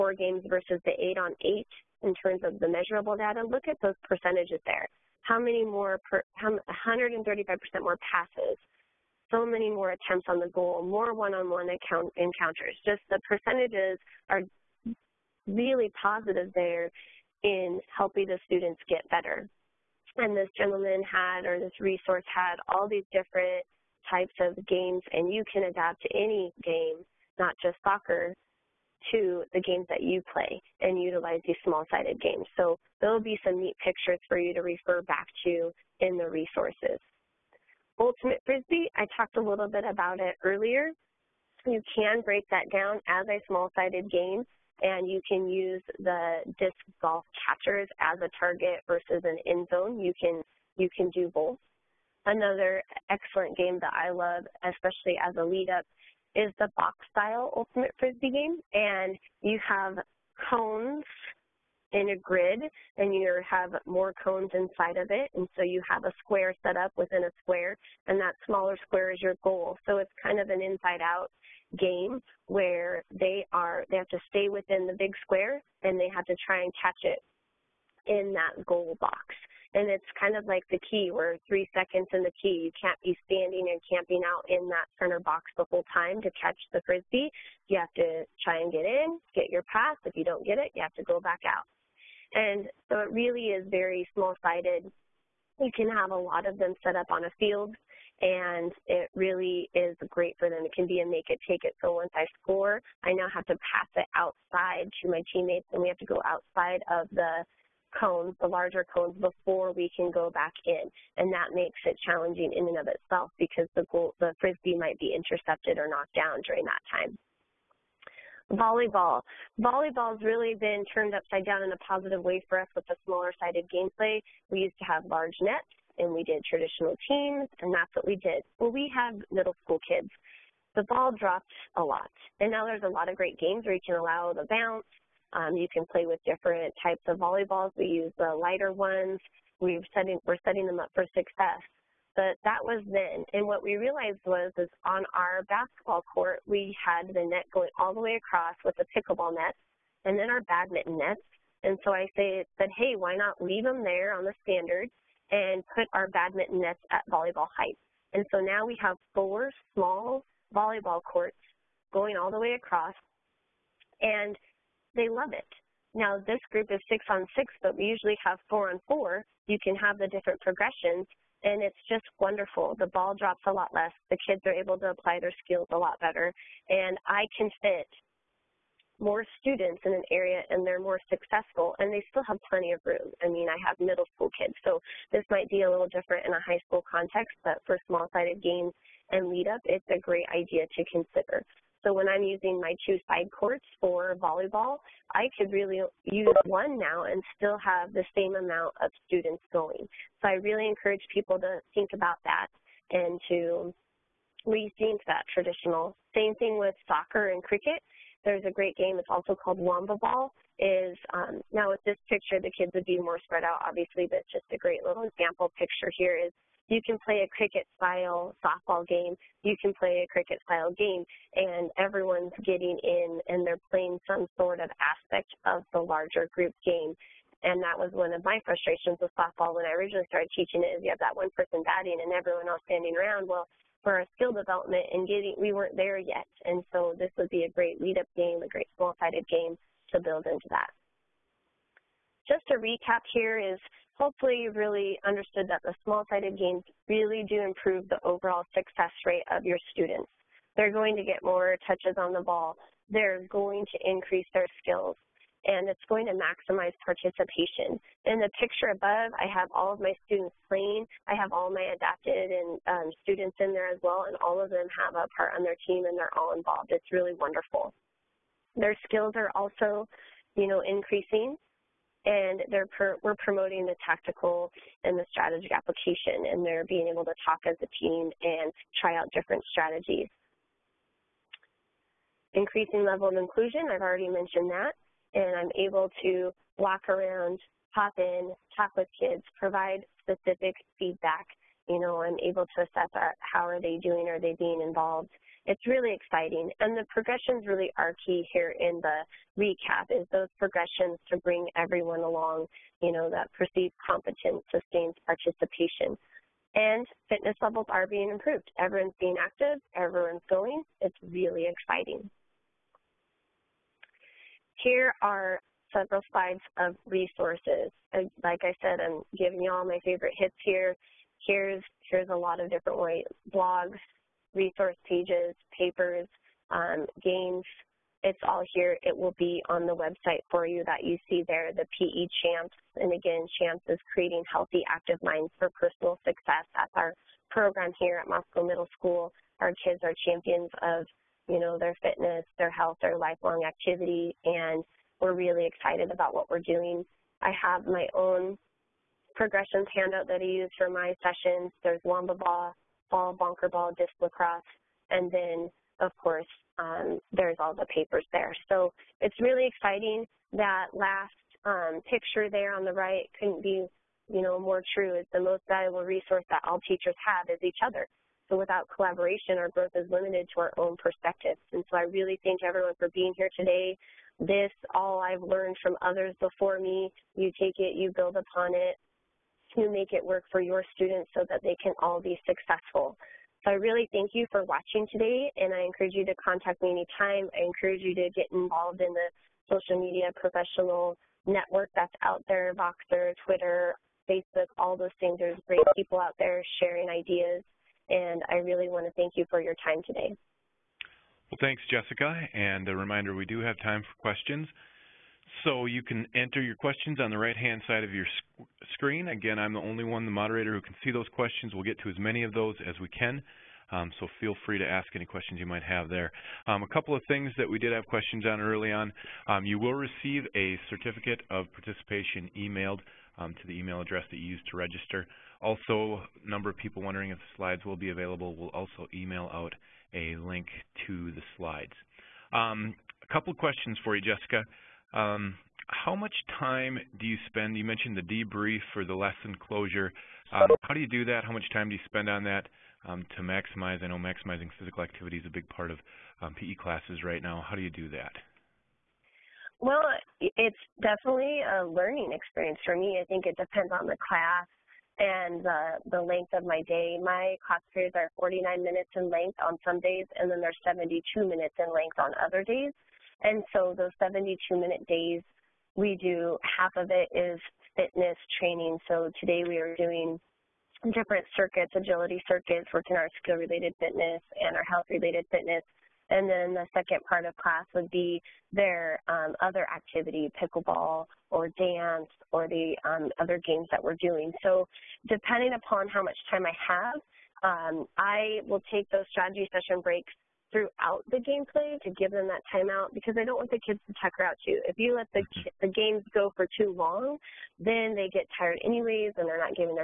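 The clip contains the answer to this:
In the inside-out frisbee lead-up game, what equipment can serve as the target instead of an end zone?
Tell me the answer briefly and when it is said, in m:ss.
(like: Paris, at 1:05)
disc golf catchers, at 0:46.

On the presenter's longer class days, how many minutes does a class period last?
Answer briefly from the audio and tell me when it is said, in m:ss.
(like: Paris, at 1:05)
72, at 7:40.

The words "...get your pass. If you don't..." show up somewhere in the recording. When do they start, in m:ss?
1:29.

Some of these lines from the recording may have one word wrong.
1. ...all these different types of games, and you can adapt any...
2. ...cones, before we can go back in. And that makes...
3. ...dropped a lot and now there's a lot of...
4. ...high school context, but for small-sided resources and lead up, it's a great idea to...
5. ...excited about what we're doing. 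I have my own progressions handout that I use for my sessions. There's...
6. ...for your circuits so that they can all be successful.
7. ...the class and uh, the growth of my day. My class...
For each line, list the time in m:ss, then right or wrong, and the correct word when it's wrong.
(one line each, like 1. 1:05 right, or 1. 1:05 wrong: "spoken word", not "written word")
1. 0:22 right
2. 1:48 right
3. 2:11 right
4. 3:06 wrong: "games", not "resources"
5. 5:45 right
6. 6:20 wrong: "students", not "circuits"
7. 7:33 wrong: "length", not "growth".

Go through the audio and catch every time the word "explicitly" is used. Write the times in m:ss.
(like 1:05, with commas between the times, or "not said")
not said.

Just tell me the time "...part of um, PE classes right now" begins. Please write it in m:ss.
7:25.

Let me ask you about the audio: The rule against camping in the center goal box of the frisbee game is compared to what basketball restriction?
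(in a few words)
three seconds in the key.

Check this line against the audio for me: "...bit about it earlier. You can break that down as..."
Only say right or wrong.
right.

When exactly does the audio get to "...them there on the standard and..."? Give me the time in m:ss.
2:33.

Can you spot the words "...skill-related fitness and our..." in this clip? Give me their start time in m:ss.
7:53.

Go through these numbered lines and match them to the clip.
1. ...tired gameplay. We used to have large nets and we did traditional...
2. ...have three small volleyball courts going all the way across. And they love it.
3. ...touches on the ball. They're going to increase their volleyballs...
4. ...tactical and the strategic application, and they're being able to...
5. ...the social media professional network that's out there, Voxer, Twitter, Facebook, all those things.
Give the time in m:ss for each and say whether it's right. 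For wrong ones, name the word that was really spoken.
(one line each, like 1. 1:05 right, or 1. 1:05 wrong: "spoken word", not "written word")
1. 2:03 wrong: "sided", not "tired"
2. 2:38 wrong: "four", not "three"
3. 4:11 wrong: "skills", not "volleyballs"
4. 4:33 right
5. 6:28 right.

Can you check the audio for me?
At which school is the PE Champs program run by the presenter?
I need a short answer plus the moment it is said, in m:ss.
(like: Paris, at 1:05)
Moscow Middle School, at 5:38.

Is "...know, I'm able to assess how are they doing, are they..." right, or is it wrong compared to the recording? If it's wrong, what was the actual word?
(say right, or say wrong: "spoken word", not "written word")
right.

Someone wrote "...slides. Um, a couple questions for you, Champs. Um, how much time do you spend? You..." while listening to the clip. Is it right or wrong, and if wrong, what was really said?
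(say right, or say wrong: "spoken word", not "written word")
wrong: "Jessica", not "Champs".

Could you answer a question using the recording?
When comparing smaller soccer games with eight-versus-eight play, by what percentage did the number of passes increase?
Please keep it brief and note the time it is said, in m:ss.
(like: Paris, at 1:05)
135%, at 0:06.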